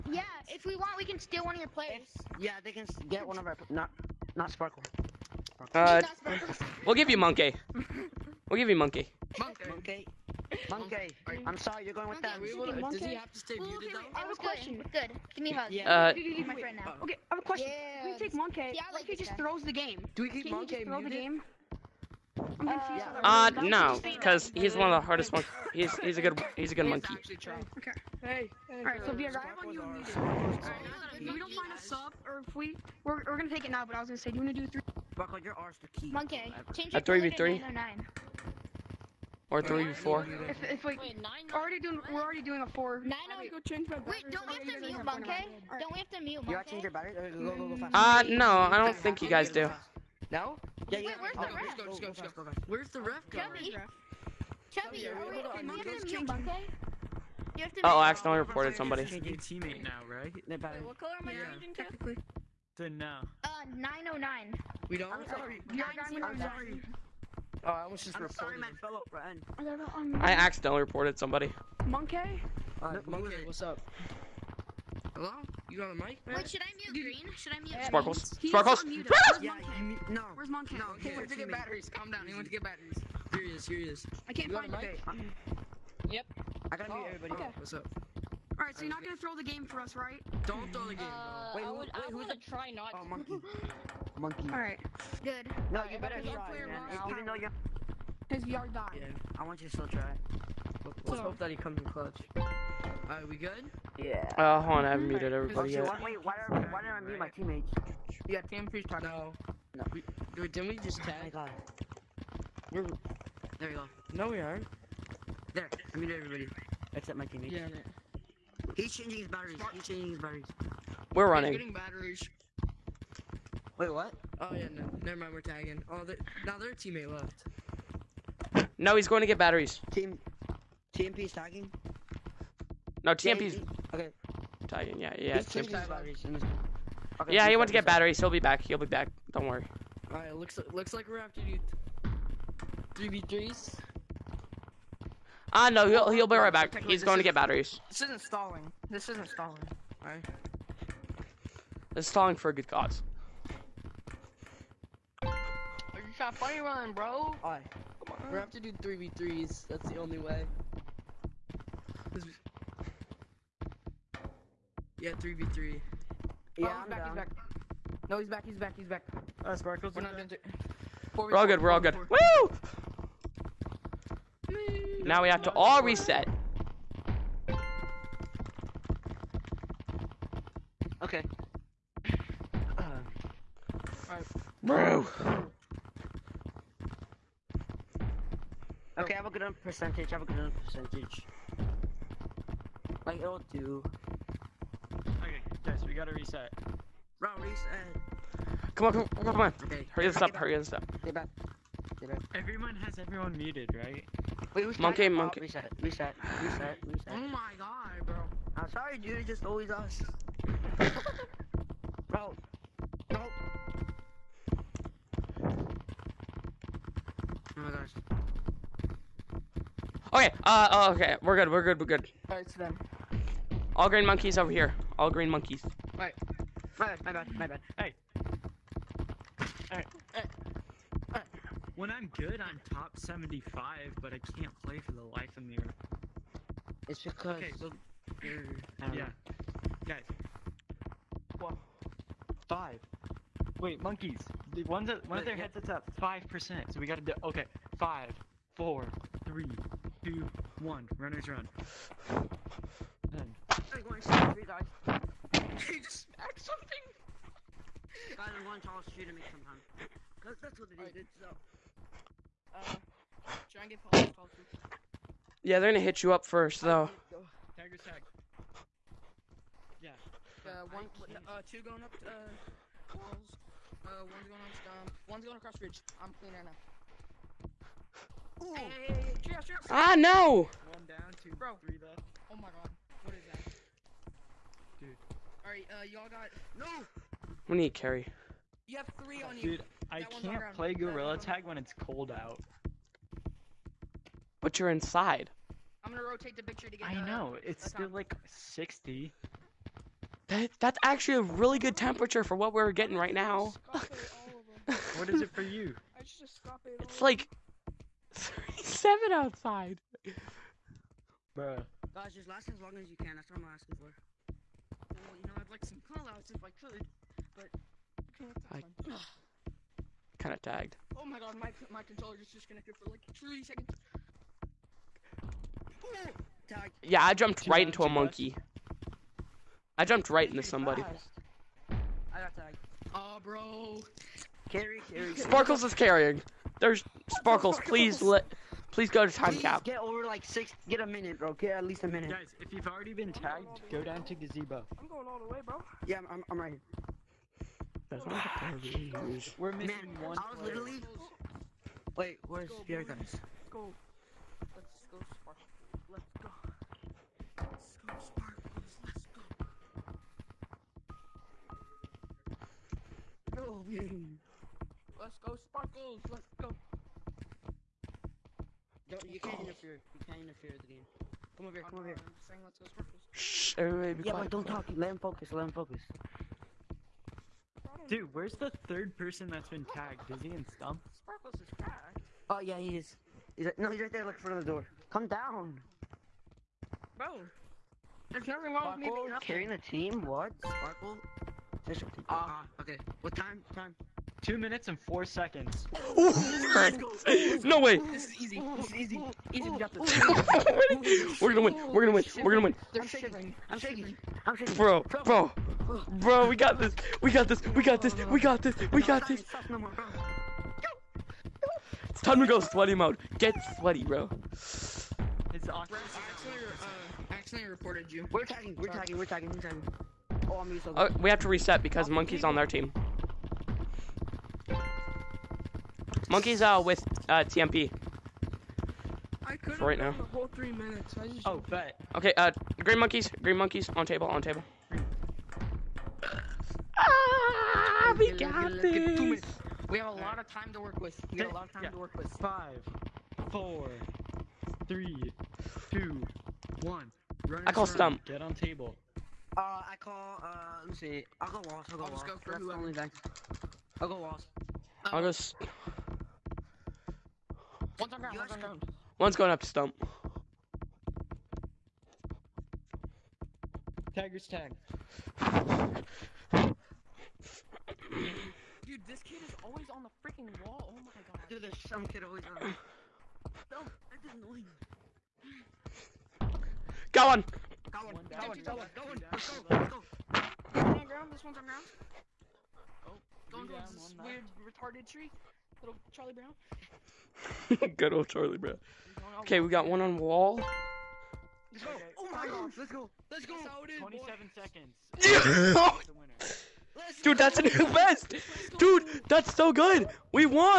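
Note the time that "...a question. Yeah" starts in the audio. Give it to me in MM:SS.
00:17.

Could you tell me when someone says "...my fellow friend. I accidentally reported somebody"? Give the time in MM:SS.
01:08.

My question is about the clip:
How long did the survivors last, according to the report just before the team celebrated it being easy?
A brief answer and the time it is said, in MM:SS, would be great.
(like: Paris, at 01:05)
2 minutes and 4 seconds, at 06:34.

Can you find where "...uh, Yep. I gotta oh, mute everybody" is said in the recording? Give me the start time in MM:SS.
01:24.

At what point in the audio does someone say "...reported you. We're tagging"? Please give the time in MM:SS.
06:57.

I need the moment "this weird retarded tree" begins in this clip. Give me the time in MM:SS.
08:03.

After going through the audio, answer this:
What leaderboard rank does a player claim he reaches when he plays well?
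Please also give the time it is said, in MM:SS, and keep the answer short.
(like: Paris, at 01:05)
top 75, at 03:52.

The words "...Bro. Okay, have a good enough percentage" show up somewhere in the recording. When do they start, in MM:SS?
03:04.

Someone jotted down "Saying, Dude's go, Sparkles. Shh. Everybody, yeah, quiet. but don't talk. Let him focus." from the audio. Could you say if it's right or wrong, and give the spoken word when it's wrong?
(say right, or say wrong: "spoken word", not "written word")
wrong: "Let", not "Dude".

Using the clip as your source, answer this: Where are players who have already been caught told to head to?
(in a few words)
gazebo.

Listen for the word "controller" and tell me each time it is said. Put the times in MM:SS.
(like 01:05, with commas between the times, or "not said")
05:21.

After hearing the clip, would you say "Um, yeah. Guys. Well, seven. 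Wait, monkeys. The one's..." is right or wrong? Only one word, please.
wrong.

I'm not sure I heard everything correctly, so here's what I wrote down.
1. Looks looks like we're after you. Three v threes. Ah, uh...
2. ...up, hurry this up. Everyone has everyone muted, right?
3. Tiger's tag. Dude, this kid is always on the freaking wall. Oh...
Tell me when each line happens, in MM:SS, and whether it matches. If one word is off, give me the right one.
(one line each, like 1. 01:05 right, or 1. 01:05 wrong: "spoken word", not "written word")
1. 02:20 right
2. 03:20 right
3. 07:43 right.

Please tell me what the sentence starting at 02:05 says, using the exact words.
Oh, they're, now their teammate left.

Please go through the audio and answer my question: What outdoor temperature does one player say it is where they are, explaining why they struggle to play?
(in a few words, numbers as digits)
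37.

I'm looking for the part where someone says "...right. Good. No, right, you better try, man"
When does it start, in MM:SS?
01:34.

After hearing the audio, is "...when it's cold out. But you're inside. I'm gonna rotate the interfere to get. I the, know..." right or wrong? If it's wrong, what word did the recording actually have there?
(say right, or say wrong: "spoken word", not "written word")
wrong: "picture", not "interfere".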